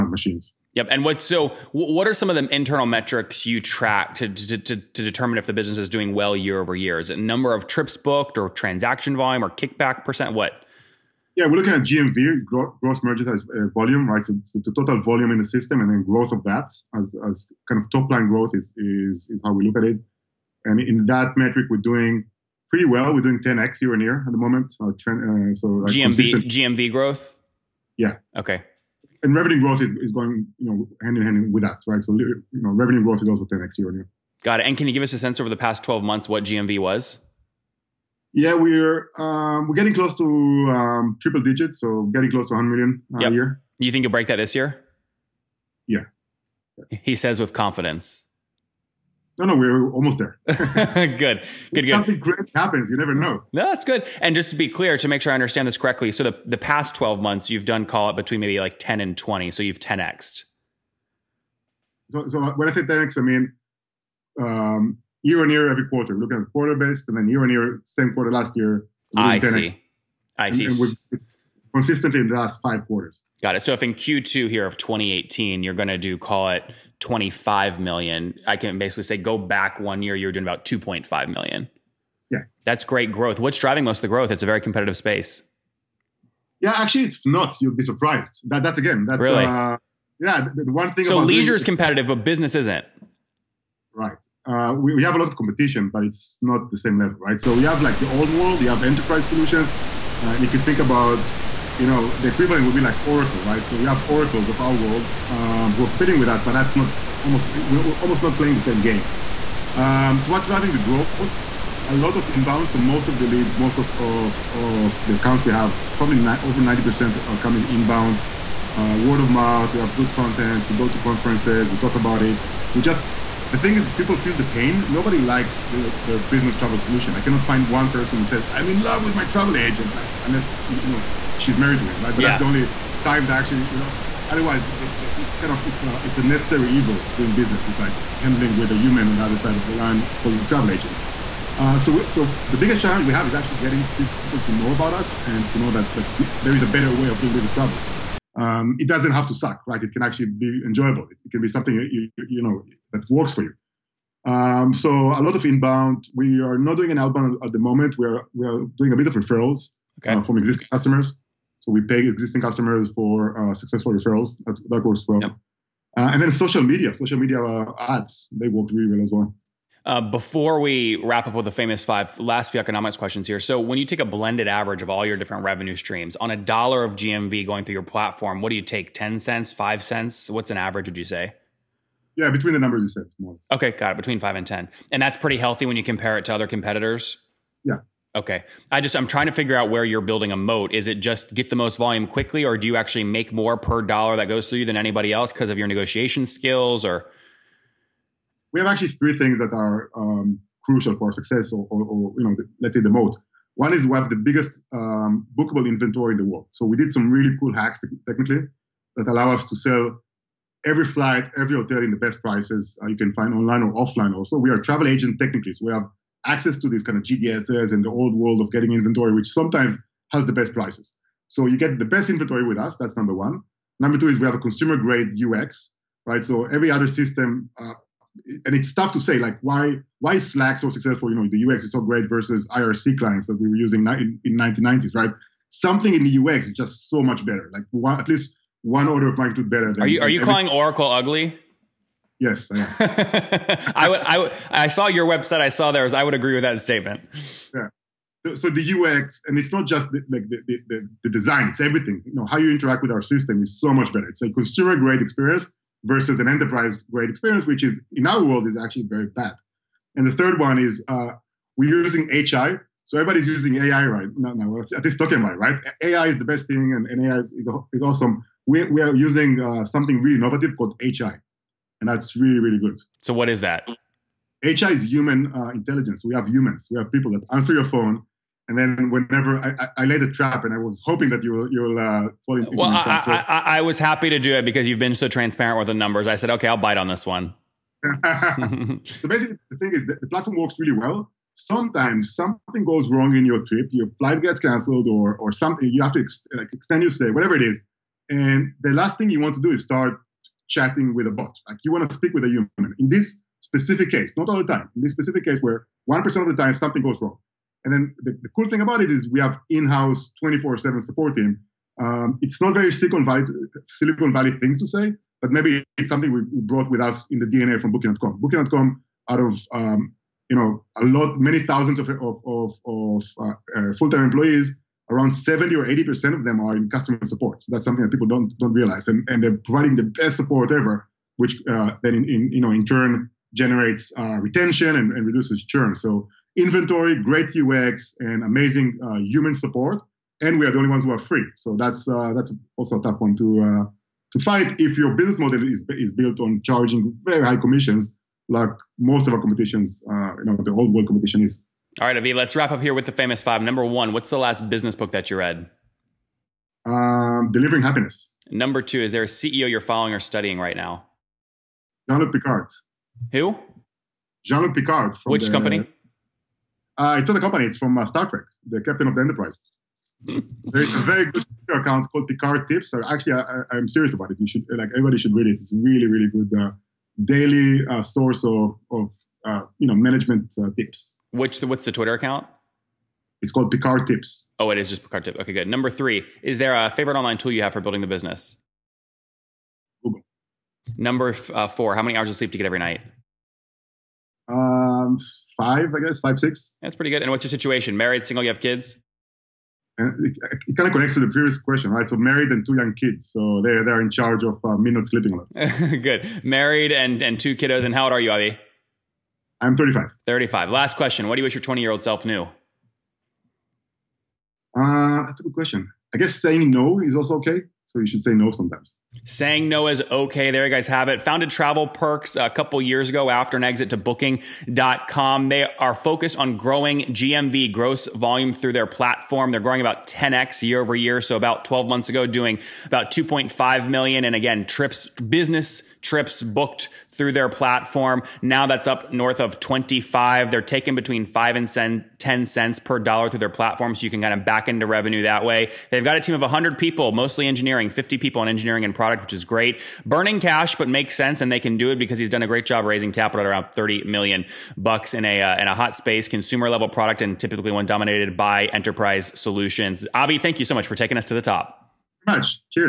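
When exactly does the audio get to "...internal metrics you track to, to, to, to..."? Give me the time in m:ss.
0:02.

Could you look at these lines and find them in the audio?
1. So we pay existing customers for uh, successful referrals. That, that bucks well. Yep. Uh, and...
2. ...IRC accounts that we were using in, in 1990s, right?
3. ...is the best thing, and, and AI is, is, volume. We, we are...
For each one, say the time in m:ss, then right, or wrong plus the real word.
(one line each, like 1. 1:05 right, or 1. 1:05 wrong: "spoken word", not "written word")
1. 2:41 wrong: "works", not "bucks"
2. 3:52 wrong: "clients", not "accounts"
3. 4:26 wrong: "awesome", not "volume".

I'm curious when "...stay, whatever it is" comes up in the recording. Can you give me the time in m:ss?
4:56.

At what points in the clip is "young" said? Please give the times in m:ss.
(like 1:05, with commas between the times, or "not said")
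6:42.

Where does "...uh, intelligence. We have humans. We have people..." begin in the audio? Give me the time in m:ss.
4:35.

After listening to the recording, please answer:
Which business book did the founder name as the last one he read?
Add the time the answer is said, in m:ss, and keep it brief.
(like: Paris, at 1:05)
Delivering Happiness, at 5:57.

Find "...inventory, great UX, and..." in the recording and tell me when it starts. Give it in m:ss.
5:36.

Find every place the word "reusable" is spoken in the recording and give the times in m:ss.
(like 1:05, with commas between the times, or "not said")
not said.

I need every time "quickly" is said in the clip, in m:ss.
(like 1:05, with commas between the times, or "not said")
3:12.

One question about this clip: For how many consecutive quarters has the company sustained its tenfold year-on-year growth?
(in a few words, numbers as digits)
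5.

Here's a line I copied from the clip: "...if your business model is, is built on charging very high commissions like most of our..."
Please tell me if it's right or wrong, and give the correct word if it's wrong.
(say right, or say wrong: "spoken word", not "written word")
right.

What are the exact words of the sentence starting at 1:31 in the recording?
So leisure is competitive, but business isn't.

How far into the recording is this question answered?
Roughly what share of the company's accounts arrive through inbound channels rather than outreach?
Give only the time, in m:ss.
1:56.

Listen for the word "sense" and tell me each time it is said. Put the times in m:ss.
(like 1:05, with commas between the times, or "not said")
0:35, 7:30.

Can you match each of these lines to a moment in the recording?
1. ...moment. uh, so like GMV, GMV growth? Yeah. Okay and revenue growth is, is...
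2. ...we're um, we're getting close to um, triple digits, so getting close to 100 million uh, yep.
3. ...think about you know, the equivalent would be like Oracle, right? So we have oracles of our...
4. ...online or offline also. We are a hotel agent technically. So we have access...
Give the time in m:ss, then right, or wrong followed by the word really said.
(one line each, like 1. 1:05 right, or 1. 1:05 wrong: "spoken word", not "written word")
1. 0:24 right
2. 0:38 right
3. 1:40 right
4. 3:33 wrong: "travel", not "hotel".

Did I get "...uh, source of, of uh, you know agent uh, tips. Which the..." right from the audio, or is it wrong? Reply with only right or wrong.
wrong.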